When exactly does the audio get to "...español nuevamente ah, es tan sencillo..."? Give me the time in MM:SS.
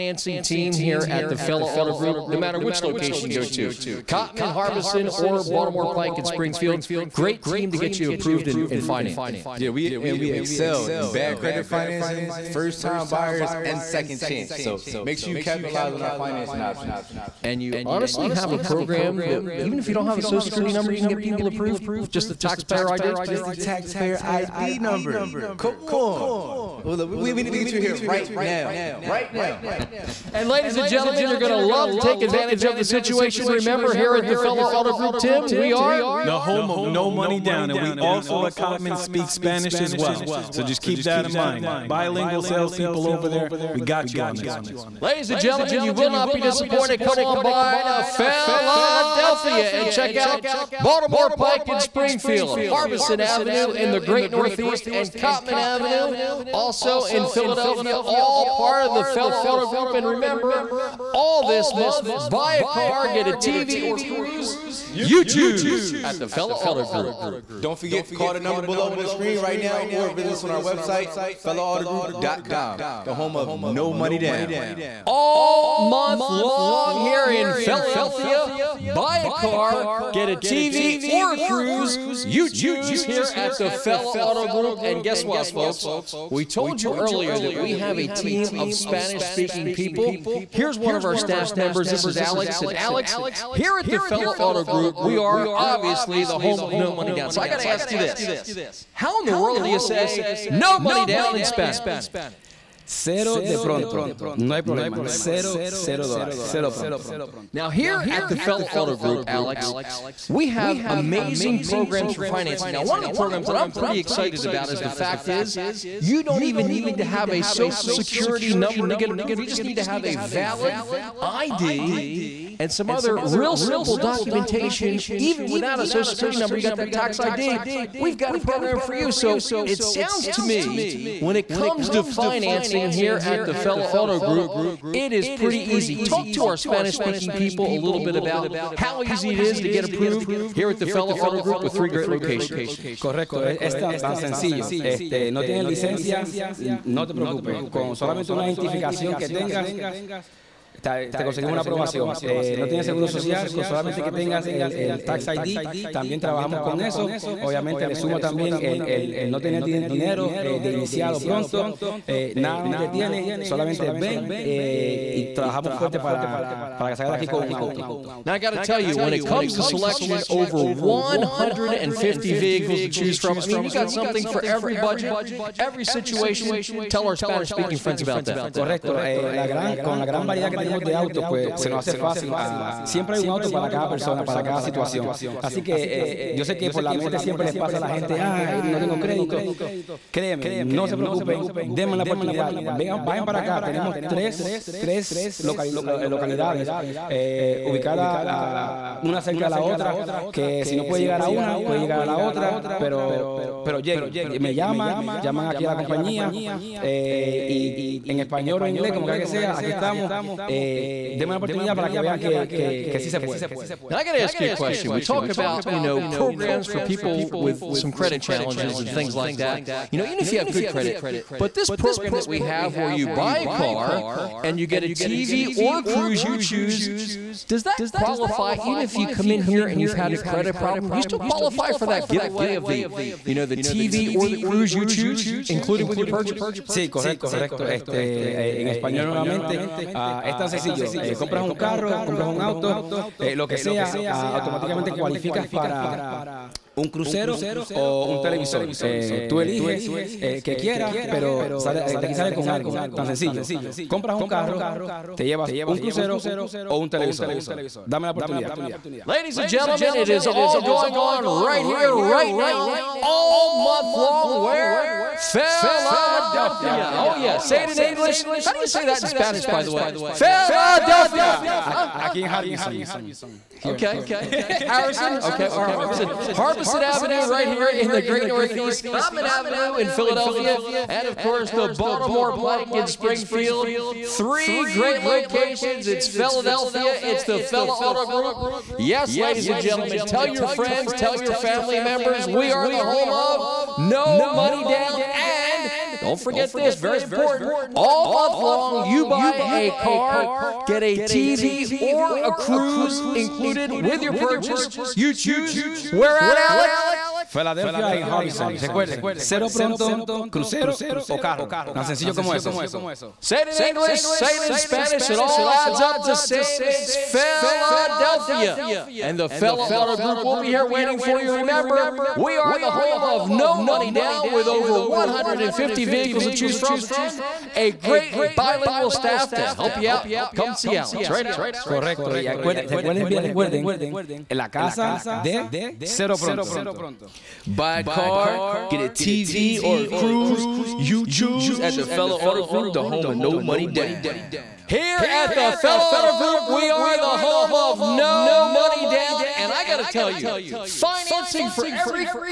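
03:58.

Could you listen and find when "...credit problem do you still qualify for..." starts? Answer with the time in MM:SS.
03:50.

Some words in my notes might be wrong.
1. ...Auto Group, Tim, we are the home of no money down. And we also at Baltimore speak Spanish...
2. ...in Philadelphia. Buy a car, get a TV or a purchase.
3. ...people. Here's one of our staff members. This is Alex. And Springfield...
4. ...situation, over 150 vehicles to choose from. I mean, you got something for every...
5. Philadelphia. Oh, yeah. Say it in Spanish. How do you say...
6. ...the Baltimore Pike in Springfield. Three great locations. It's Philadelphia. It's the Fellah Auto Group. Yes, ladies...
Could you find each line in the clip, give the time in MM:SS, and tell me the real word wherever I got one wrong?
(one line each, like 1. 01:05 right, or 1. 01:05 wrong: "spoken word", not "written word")
1. 00:34 wrong: "Cottman", not "Baltimore"
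2. 01:17 wrong: "cruise", not "purchase"
3. 01:29 wrong: "Alex", not "Springfield"
4. 02:49 wrong: "selection", not "situation"
5. 04:25 wrong: "English", not "Spanish"
6. 04:41 right.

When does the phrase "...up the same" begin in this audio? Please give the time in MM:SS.
05:15.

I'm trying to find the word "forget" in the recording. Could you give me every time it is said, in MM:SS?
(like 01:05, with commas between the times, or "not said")
01:07, 04:56.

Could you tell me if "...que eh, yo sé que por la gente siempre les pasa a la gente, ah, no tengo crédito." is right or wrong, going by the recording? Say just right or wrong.
wrong.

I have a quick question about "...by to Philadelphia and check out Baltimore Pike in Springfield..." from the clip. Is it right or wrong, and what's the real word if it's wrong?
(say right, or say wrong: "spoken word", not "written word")
right.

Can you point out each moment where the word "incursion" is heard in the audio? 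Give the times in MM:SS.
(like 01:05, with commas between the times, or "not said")
not said.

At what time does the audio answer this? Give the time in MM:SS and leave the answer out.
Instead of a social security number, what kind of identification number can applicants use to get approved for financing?
00:23.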